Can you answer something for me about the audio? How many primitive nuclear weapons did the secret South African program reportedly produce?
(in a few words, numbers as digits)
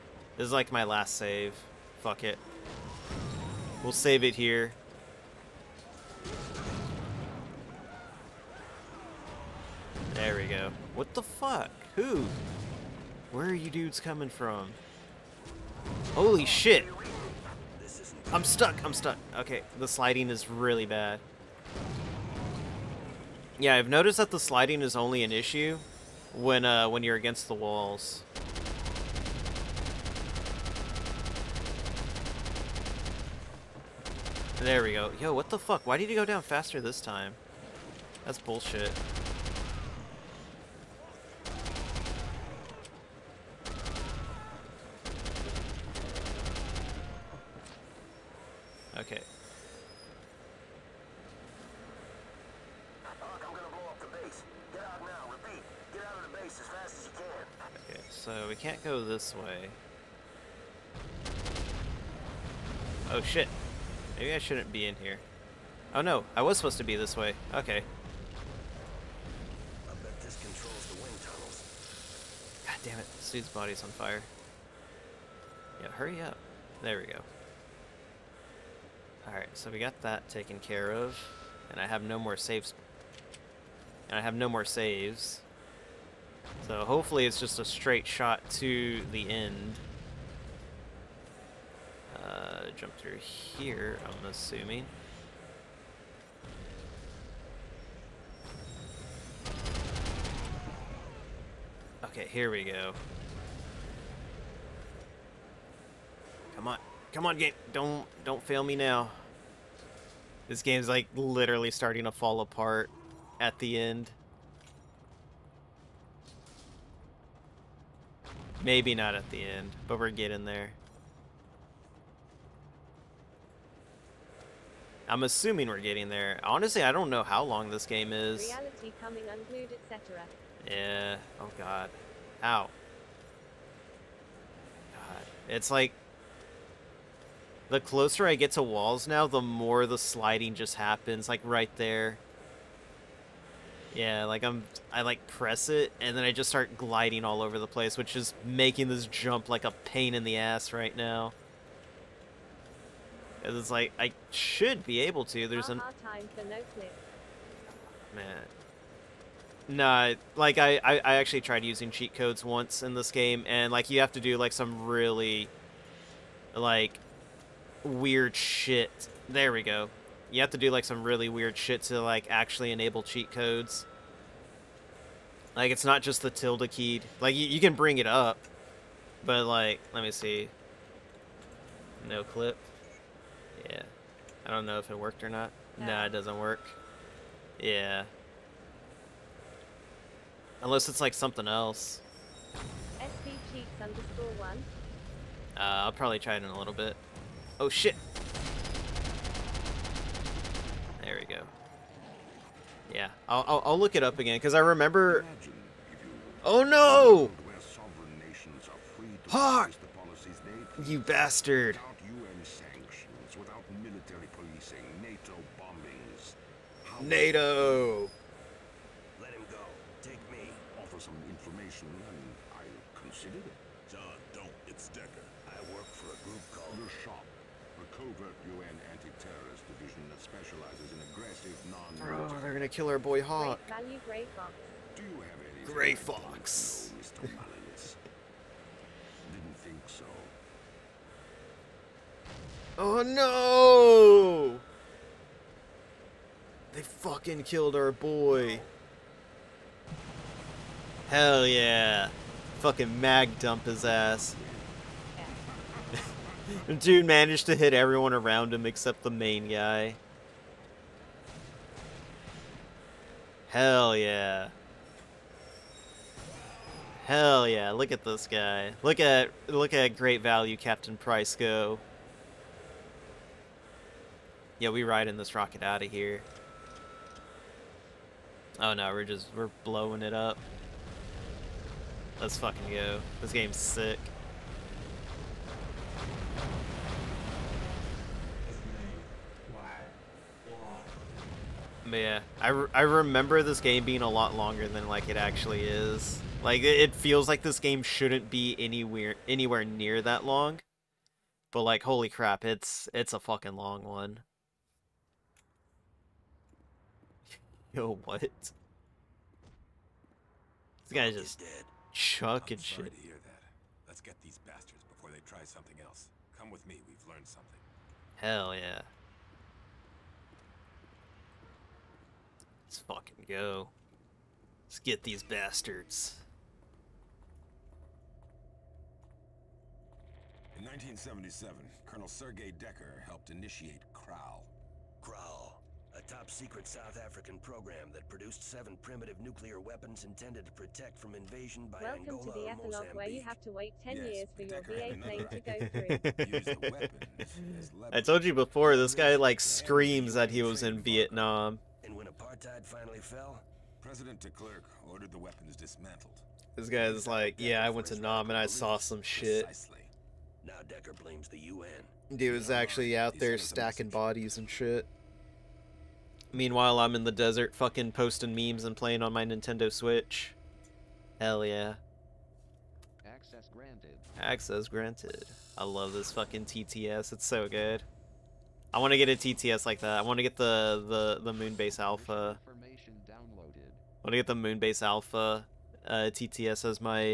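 7.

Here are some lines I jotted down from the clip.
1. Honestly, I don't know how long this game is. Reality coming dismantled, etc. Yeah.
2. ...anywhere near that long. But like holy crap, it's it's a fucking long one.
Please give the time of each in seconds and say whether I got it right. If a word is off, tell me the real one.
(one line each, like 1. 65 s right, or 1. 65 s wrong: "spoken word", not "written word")
1. 126 s wrong: "unglued", not "dismantled"
2. 299 s right.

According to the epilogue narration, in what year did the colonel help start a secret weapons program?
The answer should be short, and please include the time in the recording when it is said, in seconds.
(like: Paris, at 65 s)
1977, at 330 s.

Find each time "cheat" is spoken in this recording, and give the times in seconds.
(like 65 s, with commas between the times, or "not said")
161 s, 173 s, 193 s.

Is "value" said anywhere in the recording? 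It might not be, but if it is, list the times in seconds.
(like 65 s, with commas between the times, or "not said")
233 s, 270 s.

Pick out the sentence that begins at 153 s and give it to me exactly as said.
Cause it's like I should be able to.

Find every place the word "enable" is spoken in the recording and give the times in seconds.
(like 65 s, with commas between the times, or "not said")
172 s.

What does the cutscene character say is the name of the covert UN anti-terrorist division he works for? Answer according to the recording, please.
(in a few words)
The Shop.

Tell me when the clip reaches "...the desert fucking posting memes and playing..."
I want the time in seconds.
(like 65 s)
367 s.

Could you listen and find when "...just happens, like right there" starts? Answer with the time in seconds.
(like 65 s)
140 s.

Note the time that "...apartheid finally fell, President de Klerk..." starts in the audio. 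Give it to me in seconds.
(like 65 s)
352 s.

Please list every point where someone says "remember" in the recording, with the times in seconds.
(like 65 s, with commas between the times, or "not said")
204 s, 292 s.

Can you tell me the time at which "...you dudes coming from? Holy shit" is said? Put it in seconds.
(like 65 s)
13 s.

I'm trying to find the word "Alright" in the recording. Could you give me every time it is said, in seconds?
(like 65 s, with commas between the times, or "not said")
79 s.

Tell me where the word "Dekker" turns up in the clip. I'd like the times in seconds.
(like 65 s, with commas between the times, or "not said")
224 s, 332 s, 344 s, 360 s.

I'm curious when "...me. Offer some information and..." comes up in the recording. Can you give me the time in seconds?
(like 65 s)
220 s.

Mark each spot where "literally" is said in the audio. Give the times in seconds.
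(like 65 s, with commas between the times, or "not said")
111 s.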